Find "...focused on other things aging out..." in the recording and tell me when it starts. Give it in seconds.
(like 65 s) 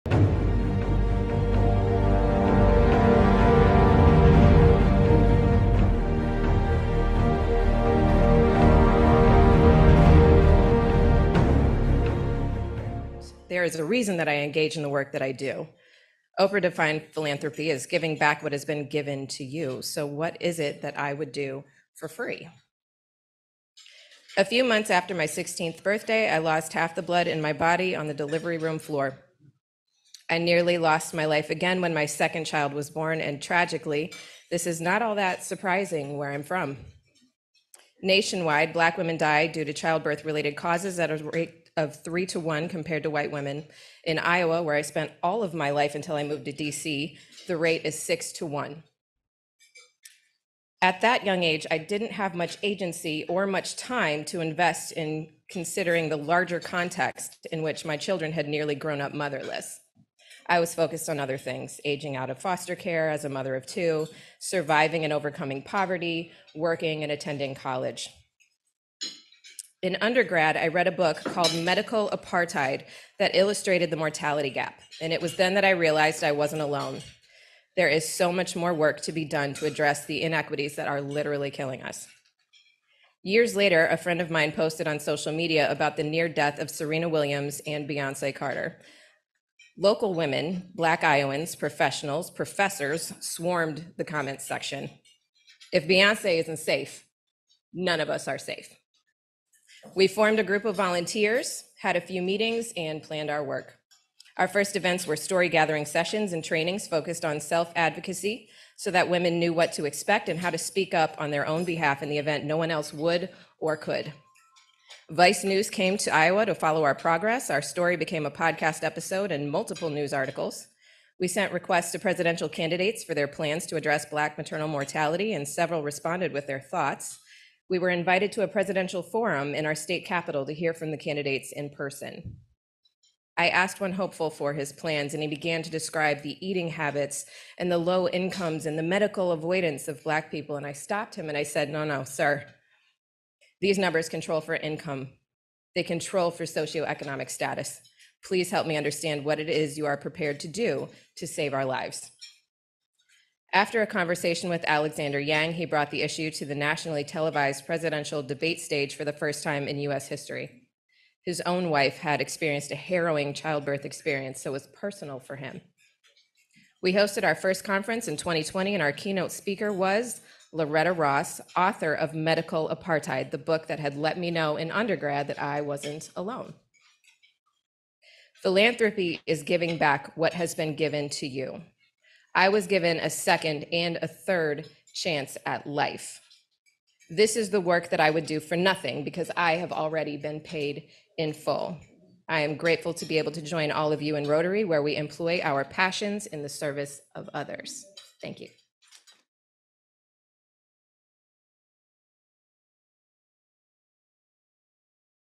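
60 s.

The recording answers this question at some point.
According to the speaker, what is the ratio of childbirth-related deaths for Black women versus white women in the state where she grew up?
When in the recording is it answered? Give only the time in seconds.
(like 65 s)
47 s.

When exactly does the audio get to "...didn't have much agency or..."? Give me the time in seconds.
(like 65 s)
51 s.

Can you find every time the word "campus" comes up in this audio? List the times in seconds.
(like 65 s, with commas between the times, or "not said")
not said.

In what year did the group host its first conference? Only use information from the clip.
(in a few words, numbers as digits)
2020.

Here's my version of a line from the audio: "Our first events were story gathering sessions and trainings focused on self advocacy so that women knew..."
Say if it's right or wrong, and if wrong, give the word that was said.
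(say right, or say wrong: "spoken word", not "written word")
right.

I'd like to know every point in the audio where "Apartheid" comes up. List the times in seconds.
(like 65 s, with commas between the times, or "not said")
72 s, 172 s.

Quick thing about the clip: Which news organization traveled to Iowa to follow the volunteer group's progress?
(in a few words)
Vice News.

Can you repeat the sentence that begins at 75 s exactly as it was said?
And it was then that I realized I wasn't alone.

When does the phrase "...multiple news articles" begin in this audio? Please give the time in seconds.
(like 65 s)
119 s.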